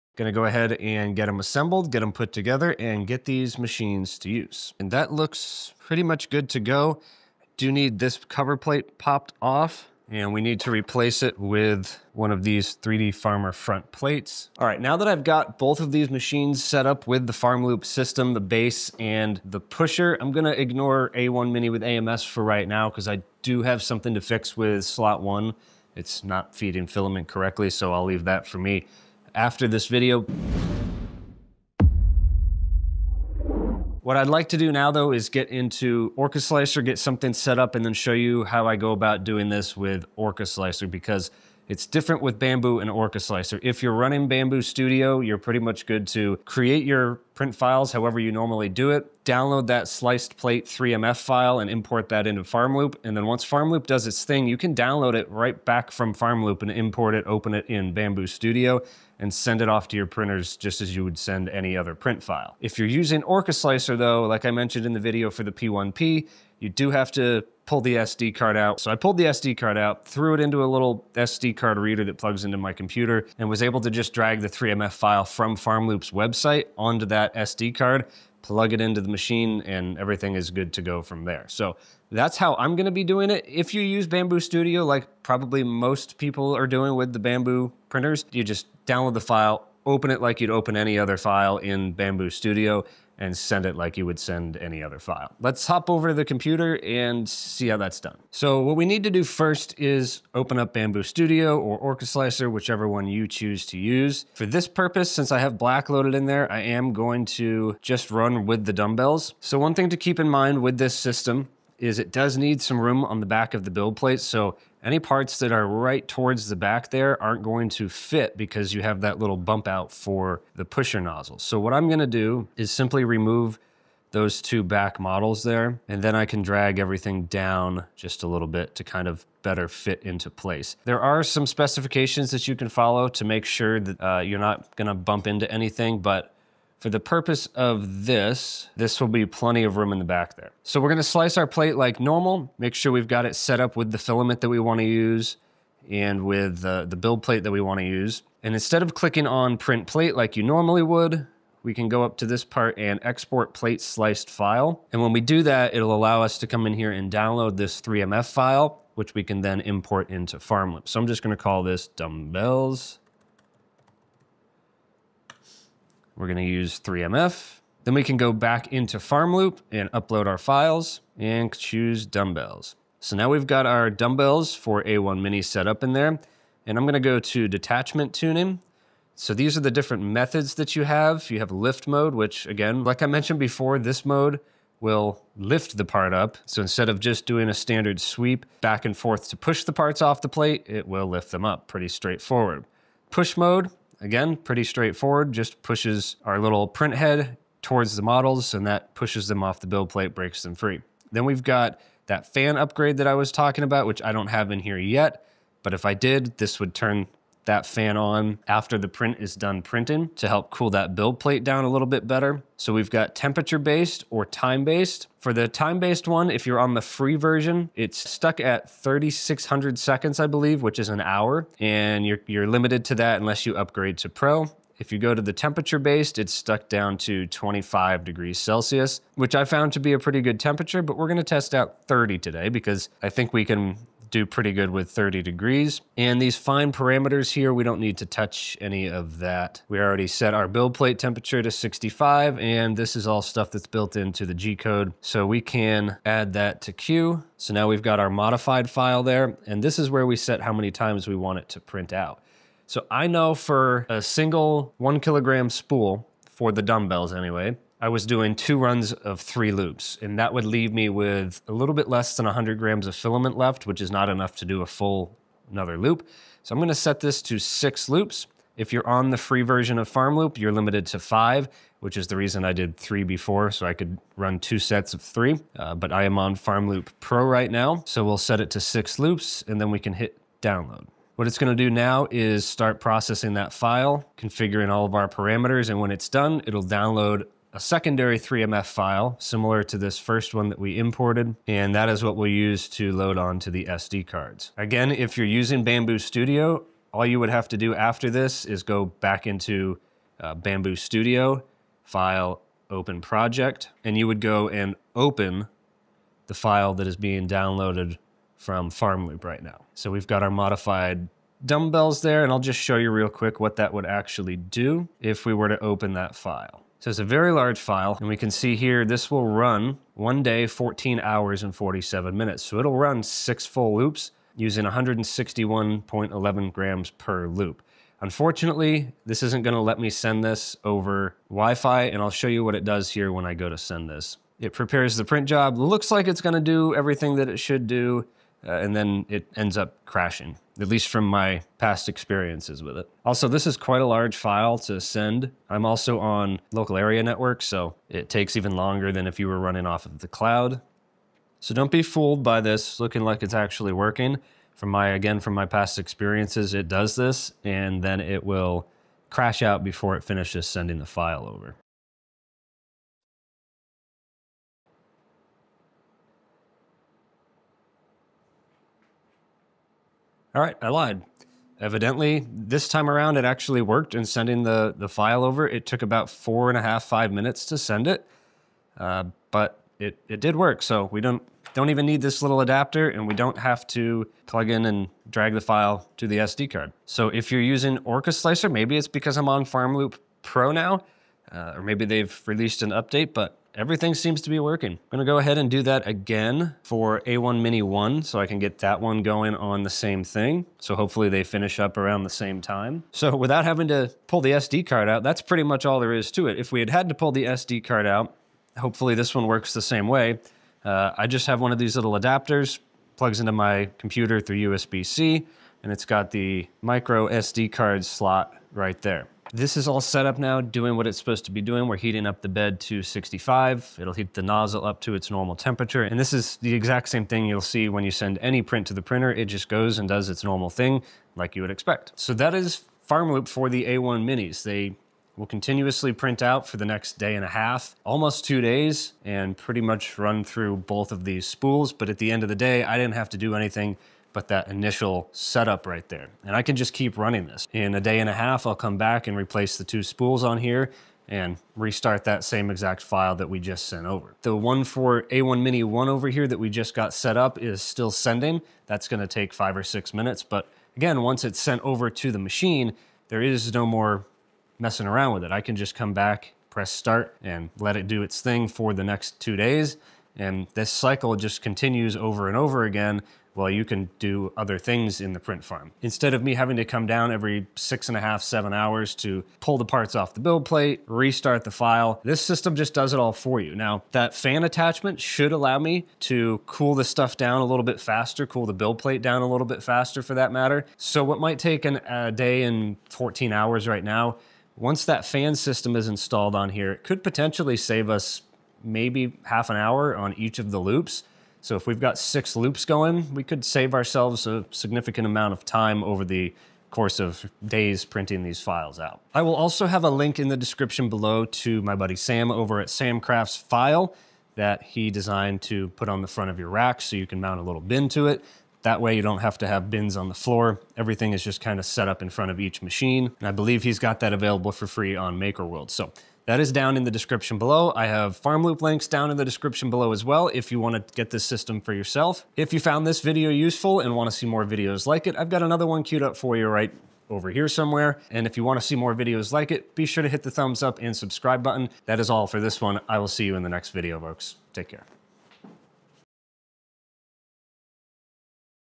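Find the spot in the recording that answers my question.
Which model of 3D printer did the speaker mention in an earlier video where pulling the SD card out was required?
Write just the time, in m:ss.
1:05.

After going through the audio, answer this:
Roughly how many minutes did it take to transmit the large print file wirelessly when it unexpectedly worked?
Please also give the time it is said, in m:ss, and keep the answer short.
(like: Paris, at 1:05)
4.5 to 5 minutes, at 6:16.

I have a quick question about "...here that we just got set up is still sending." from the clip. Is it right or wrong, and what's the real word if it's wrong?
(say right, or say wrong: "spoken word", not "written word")
right.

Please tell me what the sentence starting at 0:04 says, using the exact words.
And that looks pretty much good to go.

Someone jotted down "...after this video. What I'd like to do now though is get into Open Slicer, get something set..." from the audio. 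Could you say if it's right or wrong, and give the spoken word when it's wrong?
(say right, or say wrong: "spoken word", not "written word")
wrong: "Orca", not "Open".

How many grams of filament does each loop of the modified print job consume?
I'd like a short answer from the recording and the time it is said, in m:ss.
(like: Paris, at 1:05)
161.11, at 5:24.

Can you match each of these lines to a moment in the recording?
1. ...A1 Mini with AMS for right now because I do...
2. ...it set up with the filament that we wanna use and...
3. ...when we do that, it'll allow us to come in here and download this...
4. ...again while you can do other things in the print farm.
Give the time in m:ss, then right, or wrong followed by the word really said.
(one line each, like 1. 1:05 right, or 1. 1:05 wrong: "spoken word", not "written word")
1. 0:21 right
2. 2:23 right
3. 2:35 right
4. 7:52 right.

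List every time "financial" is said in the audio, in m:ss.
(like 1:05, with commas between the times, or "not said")
not said.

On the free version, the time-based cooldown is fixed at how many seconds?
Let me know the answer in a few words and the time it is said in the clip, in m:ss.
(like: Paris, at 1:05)
3600, at 3:38.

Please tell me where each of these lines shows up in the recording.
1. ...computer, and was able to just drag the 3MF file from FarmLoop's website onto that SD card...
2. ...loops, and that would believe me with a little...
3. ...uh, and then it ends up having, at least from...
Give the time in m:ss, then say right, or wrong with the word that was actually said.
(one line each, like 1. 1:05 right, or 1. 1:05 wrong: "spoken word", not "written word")
1. 1:12 right
2. 4:19 wrong: "leave", not "believe"
3. 5:38 wrong: "crashing", not "having".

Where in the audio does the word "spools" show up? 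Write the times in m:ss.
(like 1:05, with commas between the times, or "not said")
4:15, 7:21, 7:29.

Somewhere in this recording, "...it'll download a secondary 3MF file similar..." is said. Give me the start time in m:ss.
4:46.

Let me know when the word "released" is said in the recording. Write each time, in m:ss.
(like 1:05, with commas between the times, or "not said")
6:32.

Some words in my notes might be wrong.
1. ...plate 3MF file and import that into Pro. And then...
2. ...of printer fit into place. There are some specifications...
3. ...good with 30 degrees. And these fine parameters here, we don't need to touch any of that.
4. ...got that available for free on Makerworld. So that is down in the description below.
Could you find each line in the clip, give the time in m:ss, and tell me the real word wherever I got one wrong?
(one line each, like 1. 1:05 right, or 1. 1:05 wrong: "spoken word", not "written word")
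1. 0:50 wrong: "FarmLoop", not "Pro"
2. 2:09 wrong: "better", not "printer"
3. 3:54 right
4. 8:43 right.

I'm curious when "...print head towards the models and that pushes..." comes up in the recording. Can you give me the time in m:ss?
3:16.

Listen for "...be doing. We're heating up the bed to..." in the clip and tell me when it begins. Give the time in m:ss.
7:01.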